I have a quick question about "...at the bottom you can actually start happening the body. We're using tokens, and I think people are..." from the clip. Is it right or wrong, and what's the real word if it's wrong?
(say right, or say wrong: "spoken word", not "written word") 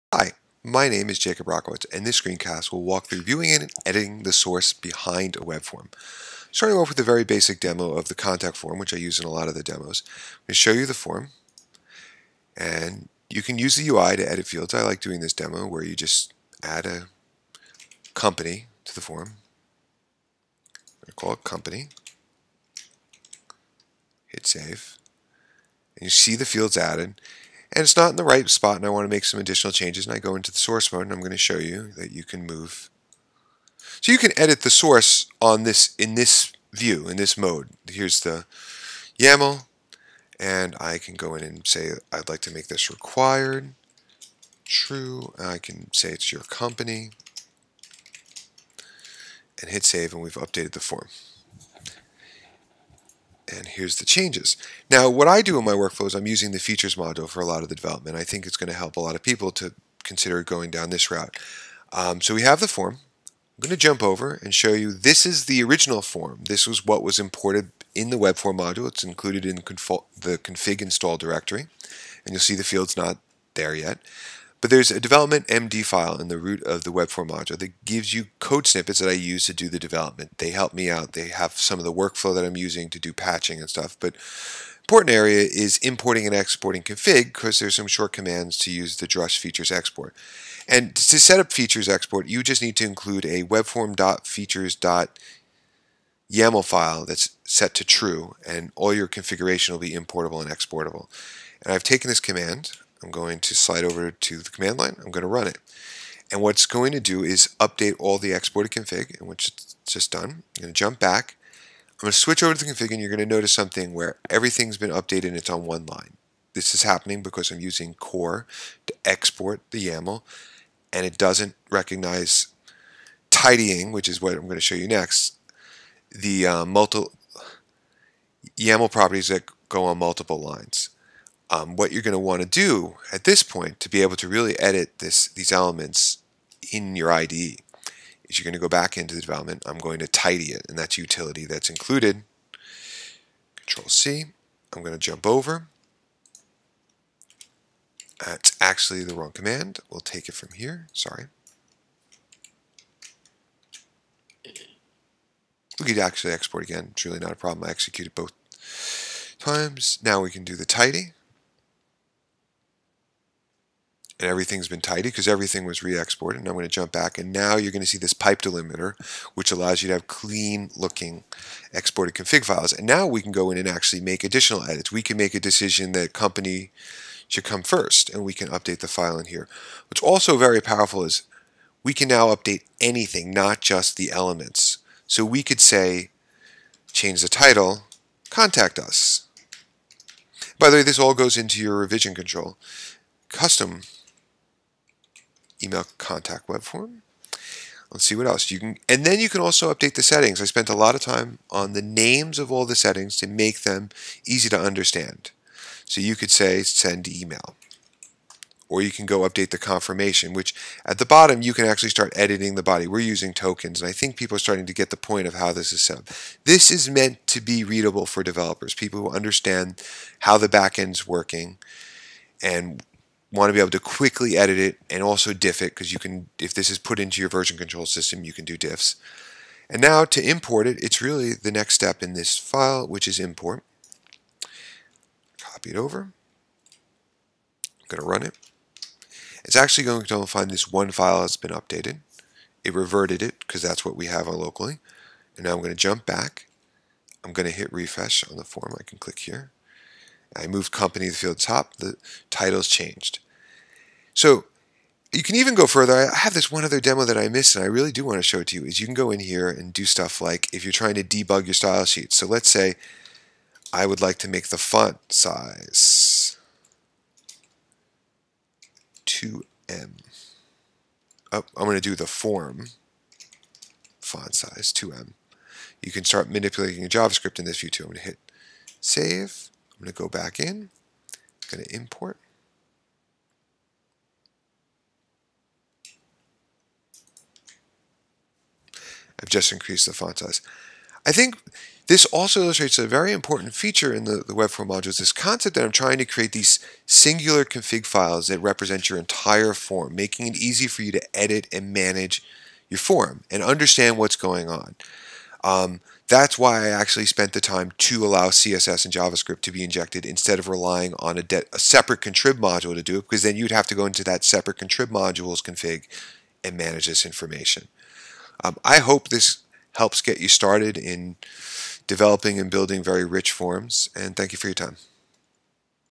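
wrong: "editing", not "happening".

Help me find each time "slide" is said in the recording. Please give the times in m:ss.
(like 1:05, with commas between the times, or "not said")
1:43.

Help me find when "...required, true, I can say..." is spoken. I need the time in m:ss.
0:42.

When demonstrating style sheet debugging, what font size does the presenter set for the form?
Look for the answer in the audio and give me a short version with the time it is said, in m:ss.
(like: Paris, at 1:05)
2em, at 4:34.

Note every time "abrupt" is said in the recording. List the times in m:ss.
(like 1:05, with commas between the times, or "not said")
not said.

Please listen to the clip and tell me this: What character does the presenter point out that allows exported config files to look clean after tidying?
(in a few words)
pipe delimiter.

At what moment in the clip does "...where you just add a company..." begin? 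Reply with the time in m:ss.
0:15.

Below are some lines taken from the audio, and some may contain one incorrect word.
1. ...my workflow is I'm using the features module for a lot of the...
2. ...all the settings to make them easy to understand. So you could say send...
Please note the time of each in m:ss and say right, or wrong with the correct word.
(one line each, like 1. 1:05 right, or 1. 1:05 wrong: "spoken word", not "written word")
1. 0:55 right
2. 3:22 right.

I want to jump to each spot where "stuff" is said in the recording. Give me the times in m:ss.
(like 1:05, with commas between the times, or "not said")
1:23, 4:19.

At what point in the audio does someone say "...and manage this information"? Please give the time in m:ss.
5:16.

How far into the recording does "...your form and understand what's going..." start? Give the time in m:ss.
5:02.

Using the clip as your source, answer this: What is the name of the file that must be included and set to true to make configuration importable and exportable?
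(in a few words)
webform.features.yaml.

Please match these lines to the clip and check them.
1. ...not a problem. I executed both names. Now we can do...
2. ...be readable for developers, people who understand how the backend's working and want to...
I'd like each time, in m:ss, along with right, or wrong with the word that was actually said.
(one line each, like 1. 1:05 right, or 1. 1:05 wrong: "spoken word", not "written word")
1. 2:37 wrong: "times", not "names"
2. 3:37 right.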